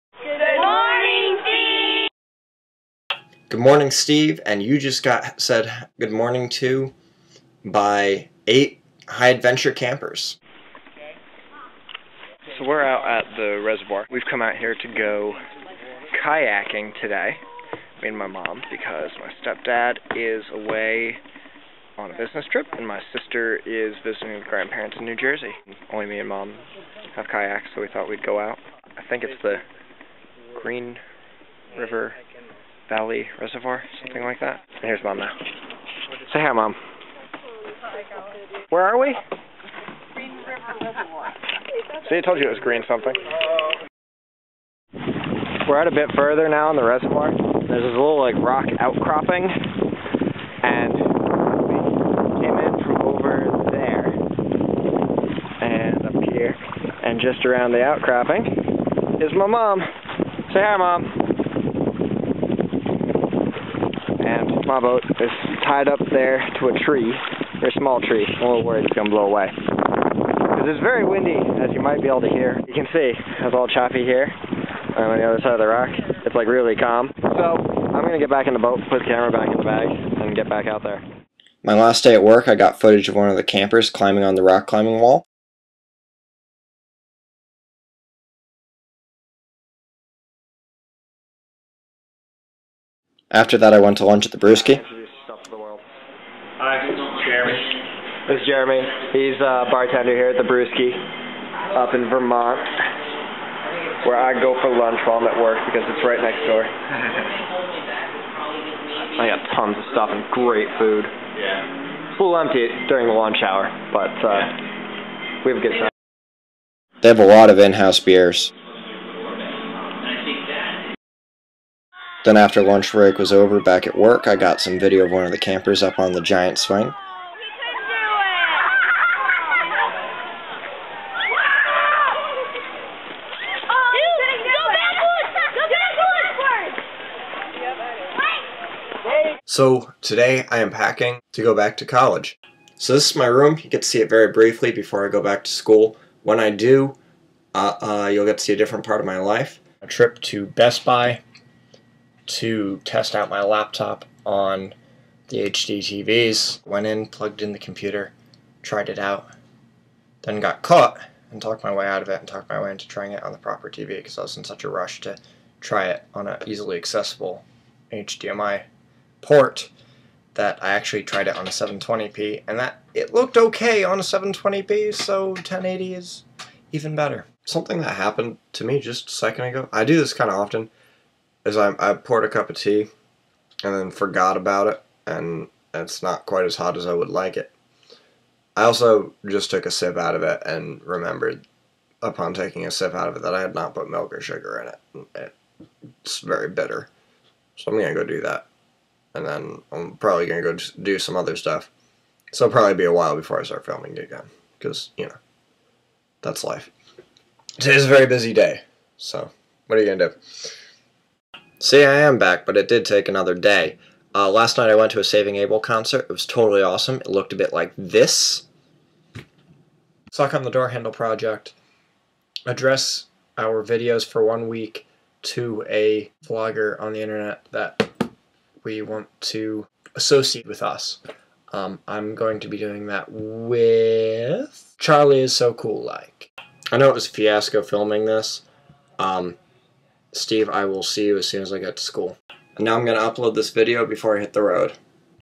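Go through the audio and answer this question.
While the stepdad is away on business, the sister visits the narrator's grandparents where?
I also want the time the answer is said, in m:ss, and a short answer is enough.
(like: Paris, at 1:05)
New Jersey, at 0:25.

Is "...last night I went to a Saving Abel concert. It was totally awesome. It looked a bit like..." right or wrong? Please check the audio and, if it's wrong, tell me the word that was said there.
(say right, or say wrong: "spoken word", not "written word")
right.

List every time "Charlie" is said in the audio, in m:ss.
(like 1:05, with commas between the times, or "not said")
3:54.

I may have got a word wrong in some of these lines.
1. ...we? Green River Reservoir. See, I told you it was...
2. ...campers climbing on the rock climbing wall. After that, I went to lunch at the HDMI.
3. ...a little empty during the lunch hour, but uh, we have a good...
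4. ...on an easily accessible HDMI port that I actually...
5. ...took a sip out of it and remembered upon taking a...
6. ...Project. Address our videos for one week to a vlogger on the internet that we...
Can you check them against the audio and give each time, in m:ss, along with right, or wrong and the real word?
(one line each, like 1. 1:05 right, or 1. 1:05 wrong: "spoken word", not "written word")
1. 0:38 right
2. 1:23 wrong: "Brewski", not "HDMI"
3. 1:52 right
4. 2:46 right
5. 3:09 right
6. 3:40 right.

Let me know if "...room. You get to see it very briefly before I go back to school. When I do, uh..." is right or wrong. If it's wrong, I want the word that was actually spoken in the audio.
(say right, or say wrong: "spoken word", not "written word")
right.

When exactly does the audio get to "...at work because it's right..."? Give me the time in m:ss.
1:45.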